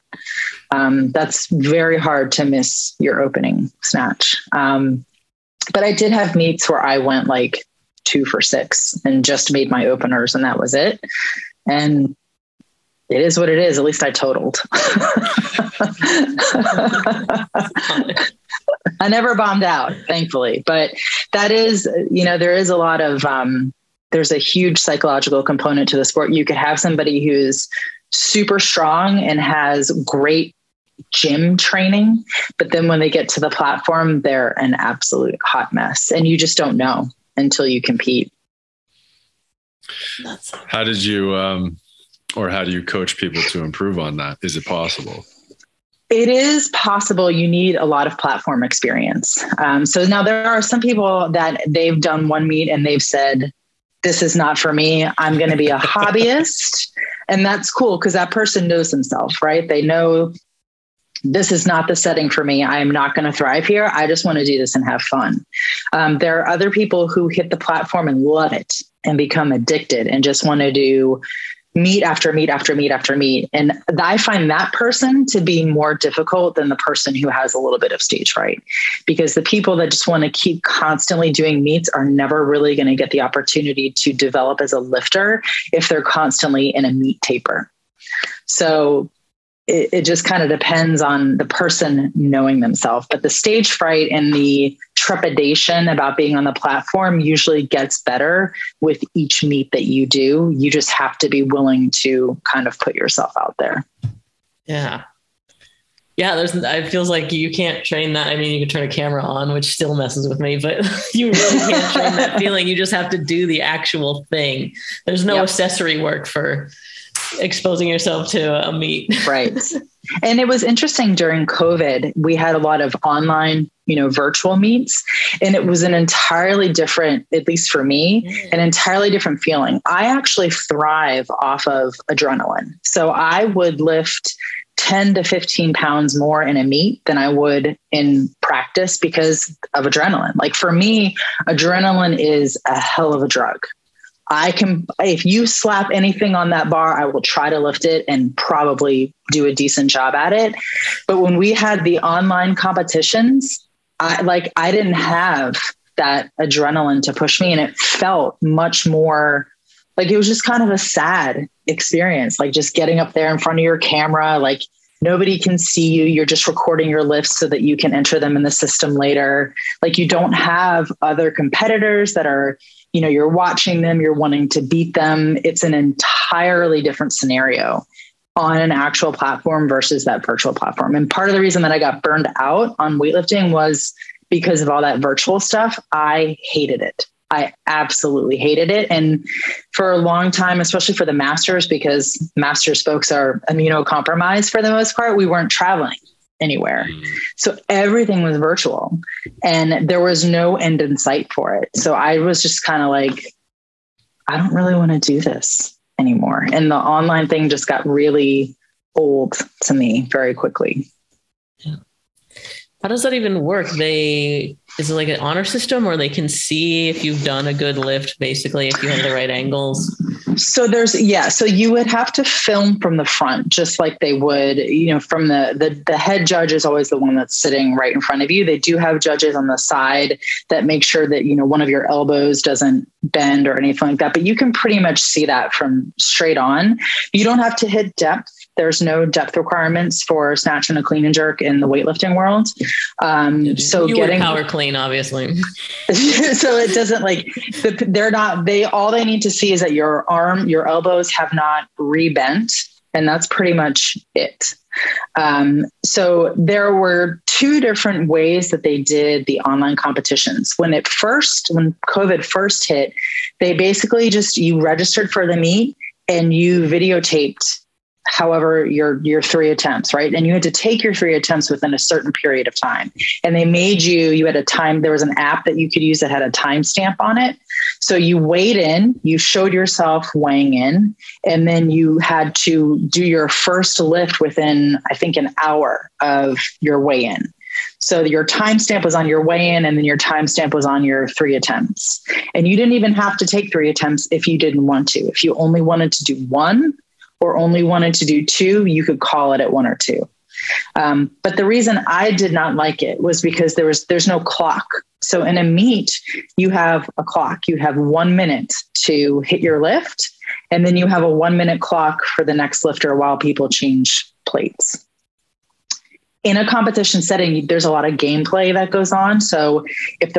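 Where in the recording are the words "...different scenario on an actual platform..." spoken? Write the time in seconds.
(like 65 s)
176 s.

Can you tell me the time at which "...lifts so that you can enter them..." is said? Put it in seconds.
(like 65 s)
167 s.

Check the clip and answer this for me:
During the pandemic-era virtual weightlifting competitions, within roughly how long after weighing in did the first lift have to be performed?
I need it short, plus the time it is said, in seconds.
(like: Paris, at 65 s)
an hour, at 284 s.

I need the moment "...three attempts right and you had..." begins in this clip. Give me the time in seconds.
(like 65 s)
269 s.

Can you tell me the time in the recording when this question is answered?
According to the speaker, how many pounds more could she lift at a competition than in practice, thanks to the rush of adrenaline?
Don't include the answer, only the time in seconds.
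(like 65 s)
134 s.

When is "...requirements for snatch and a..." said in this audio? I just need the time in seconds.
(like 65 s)
239 s.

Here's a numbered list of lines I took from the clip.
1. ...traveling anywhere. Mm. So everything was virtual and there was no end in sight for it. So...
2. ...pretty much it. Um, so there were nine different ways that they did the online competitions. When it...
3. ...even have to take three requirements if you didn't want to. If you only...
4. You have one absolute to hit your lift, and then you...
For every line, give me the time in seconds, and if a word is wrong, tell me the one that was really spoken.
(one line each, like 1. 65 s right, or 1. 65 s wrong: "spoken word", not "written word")
1. 195 s right
2. 253 s wrong: "two", not "nine"
3. 292 s wrong: "attempts", not "requirements"
4. 307 s wrong: "minute", not "absolute".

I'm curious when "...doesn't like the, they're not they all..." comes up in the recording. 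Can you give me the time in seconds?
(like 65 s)
246 s.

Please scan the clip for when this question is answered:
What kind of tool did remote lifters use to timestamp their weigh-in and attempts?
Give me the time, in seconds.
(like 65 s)
275 s.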